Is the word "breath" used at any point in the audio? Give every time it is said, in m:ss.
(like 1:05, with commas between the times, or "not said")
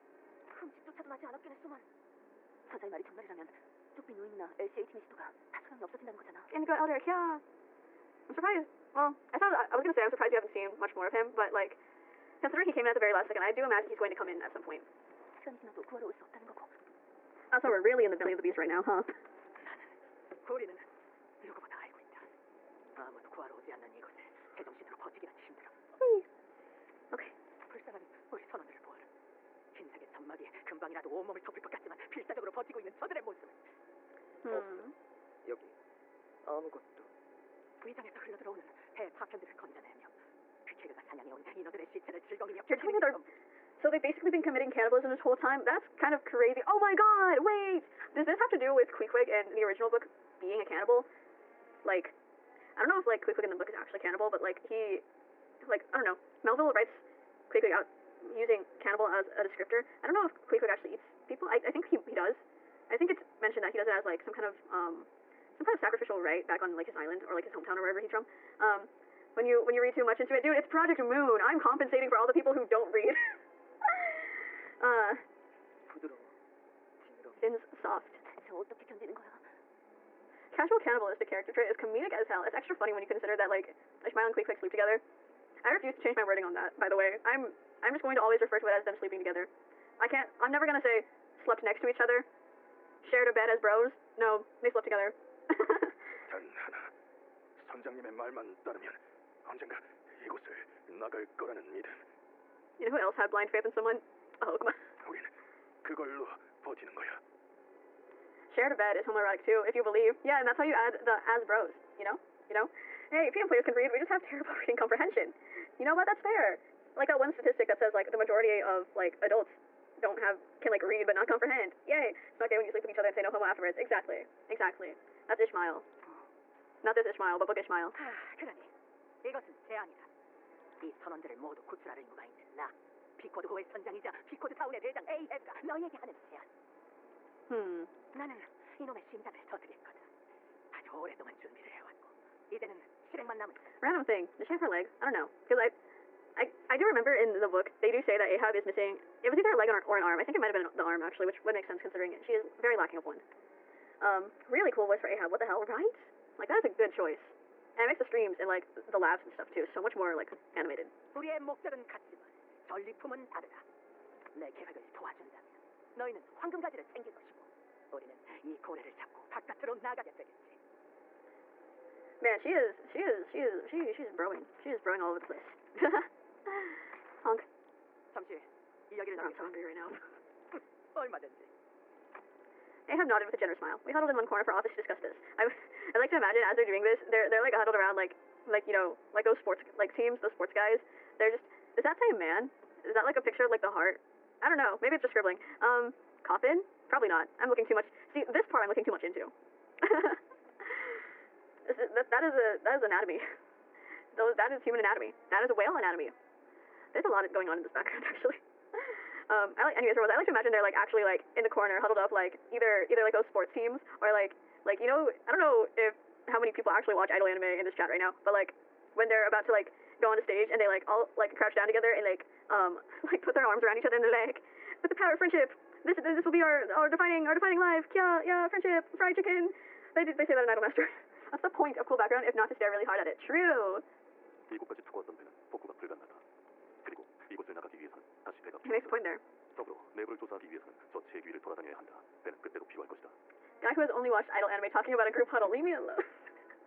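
not said.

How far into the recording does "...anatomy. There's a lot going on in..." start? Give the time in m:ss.
3:25.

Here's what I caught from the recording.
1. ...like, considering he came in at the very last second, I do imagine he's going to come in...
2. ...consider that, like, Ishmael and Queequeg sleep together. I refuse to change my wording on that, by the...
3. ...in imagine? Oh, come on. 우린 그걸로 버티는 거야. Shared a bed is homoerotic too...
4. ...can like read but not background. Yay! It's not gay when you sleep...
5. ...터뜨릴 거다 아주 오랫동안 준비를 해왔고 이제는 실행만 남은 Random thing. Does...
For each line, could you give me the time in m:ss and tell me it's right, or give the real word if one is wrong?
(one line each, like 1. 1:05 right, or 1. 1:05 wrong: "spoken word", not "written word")
1. 0:11 right
2. 1:23 right
3. 1:43 wrong: "someone", not "imagine"
4. 2:00 wrong: "comprehend", not "background"
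5. 2:19 right.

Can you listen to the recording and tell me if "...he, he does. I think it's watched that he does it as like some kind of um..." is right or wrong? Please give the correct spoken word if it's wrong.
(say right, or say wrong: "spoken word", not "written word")
wrong: "mentioned", not "watched".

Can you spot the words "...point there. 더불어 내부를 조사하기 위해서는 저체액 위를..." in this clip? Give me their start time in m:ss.
3:58.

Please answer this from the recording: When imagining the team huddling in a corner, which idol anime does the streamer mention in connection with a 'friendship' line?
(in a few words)
Idolmaster.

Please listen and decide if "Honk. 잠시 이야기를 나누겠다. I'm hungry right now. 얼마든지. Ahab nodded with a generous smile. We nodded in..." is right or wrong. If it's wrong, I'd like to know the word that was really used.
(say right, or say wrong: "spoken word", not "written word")
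wrong: "huddled", not "nodded".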